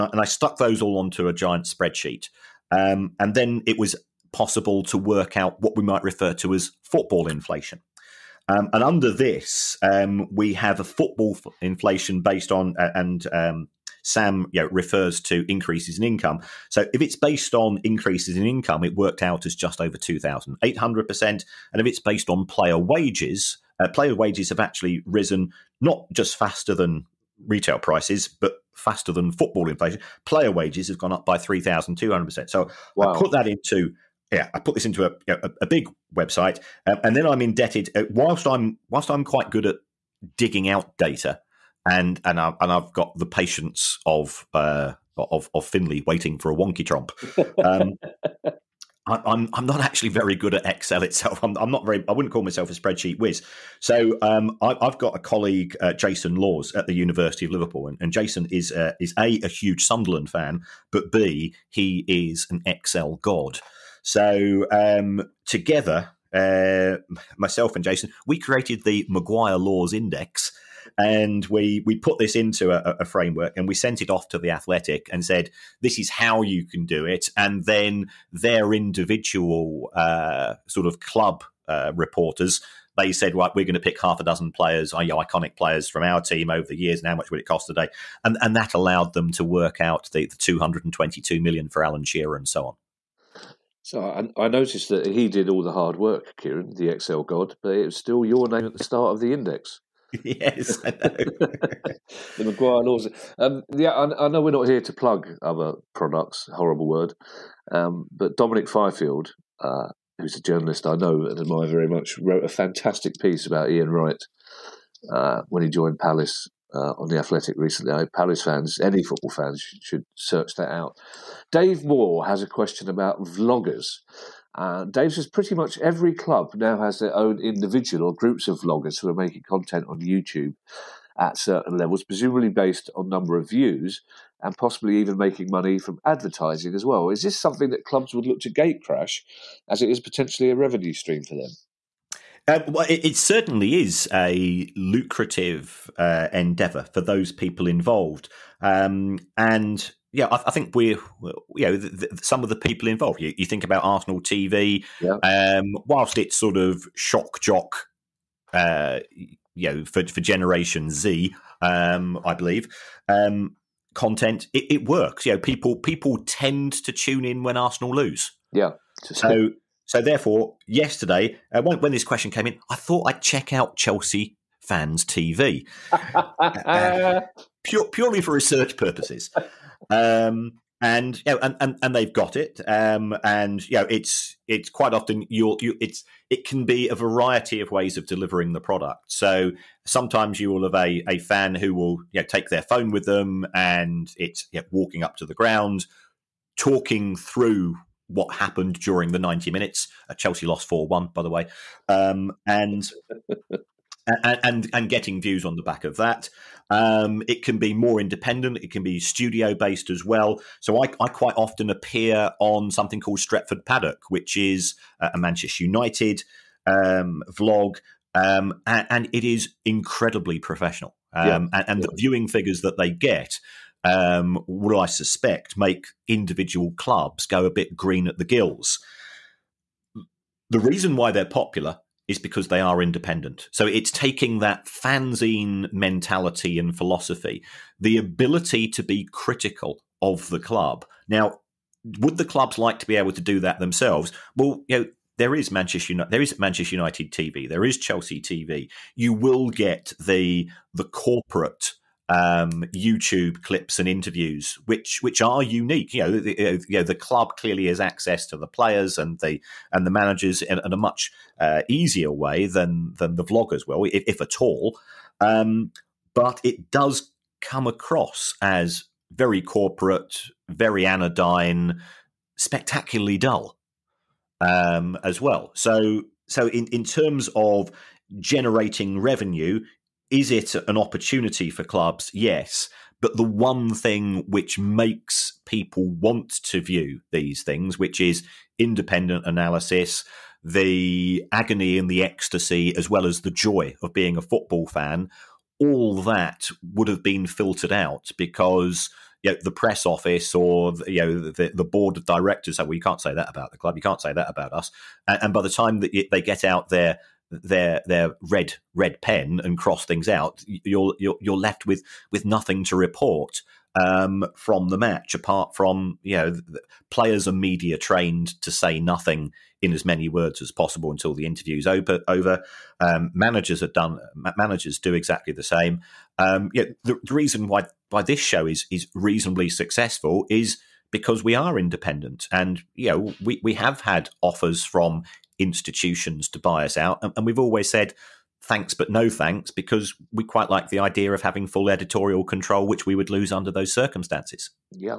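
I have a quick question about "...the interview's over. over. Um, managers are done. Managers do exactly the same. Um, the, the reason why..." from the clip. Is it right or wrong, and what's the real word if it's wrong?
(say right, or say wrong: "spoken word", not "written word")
right.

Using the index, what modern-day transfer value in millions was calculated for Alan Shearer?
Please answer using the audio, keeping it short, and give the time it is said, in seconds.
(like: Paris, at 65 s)
222 million, at 90 s.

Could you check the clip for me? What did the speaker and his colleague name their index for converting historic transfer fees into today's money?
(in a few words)
Maguire Laws Index.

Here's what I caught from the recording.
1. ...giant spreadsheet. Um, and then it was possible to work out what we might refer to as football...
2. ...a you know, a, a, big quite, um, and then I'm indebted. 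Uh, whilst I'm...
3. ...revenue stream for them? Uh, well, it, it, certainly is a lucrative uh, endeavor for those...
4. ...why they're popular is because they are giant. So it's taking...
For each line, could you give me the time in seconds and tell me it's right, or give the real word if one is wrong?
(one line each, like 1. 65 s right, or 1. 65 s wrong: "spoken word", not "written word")
1. 1 s right
2. 35 s wrong: "website", not "quite"
3. 140 s right
4. 230 s wrong: "independent", not "giant".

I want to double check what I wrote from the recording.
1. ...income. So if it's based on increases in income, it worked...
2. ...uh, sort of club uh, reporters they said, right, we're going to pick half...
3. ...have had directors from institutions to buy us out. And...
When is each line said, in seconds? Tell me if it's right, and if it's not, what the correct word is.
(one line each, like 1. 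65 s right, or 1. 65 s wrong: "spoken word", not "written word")
1. 16 s right
2. 79 s right
3. 333 s wrong: "offers", not "directors".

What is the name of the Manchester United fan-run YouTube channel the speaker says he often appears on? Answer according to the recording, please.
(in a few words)
Stretford Paddock.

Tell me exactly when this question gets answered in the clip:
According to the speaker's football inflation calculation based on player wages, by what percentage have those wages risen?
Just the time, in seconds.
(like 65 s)
31 s.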